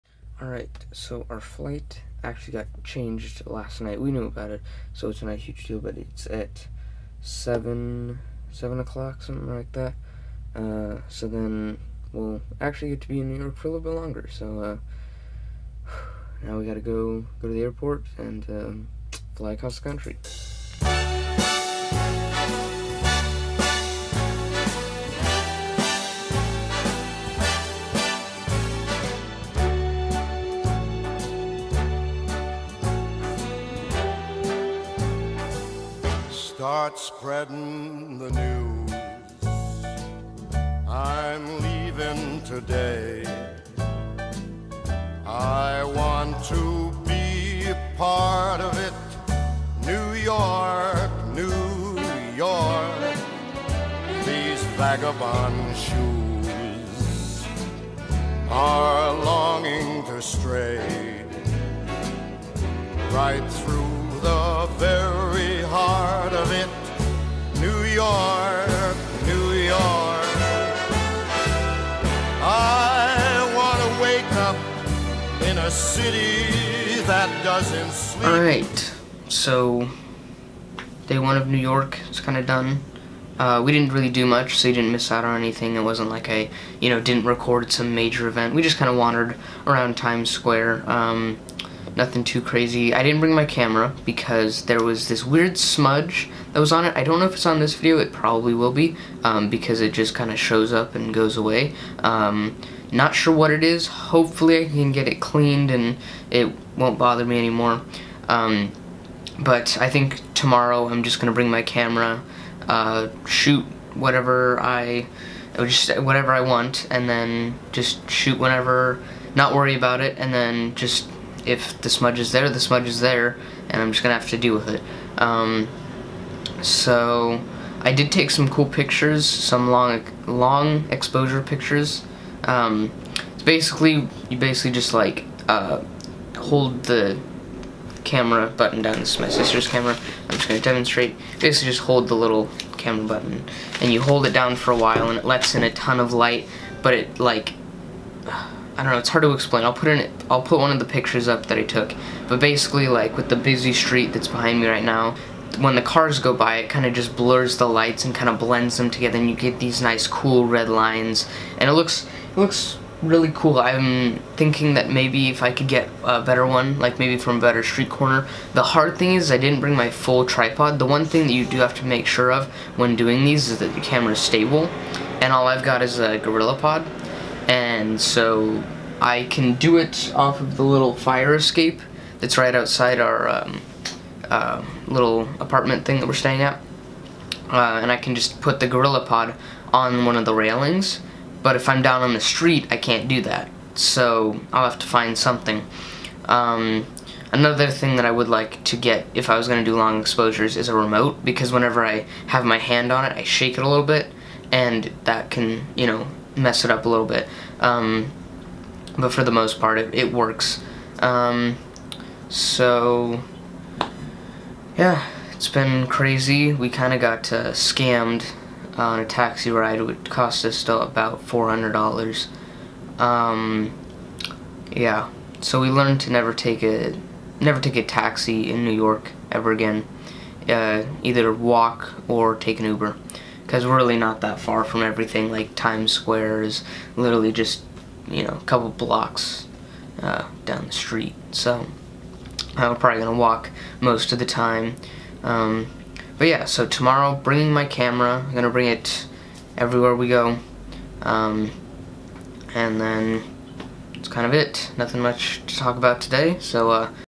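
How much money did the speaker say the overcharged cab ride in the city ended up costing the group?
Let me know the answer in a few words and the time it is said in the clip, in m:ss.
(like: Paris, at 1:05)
$400, at 3:41.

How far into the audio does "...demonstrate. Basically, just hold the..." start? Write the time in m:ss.
2:20.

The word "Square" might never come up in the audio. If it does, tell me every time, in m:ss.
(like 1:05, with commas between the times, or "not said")
1:30, 3:55.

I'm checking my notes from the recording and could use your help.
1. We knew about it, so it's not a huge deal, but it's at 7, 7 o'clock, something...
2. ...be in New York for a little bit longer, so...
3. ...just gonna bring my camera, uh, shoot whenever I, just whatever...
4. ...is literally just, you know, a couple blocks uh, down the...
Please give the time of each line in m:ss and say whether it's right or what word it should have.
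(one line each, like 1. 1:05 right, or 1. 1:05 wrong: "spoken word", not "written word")
1. 0:04 right
2. 0:13 right
3. 1:51 wrong: "whatever", not "whenever"
4. 3:56 right.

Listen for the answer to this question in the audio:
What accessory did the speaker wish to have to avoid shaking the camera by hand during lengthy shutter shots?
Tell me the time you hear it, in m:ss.
3:20.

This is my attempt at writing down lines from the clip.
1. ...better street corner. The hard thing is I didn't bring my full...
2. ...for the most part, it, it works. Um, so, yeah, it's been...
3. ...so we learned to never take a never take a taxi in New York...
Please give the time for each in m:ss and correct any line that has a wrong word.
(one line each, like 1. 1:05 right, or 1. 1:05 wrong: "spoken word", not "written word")
1. 2:47 right
2. 3:29 right
3. 3:45 right.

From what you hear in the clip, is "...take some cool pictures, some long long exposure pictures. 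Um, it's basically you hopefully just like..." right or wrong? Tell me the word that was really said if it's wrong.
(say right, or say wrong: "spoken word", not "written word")
wrong: "basically", not "hopefully".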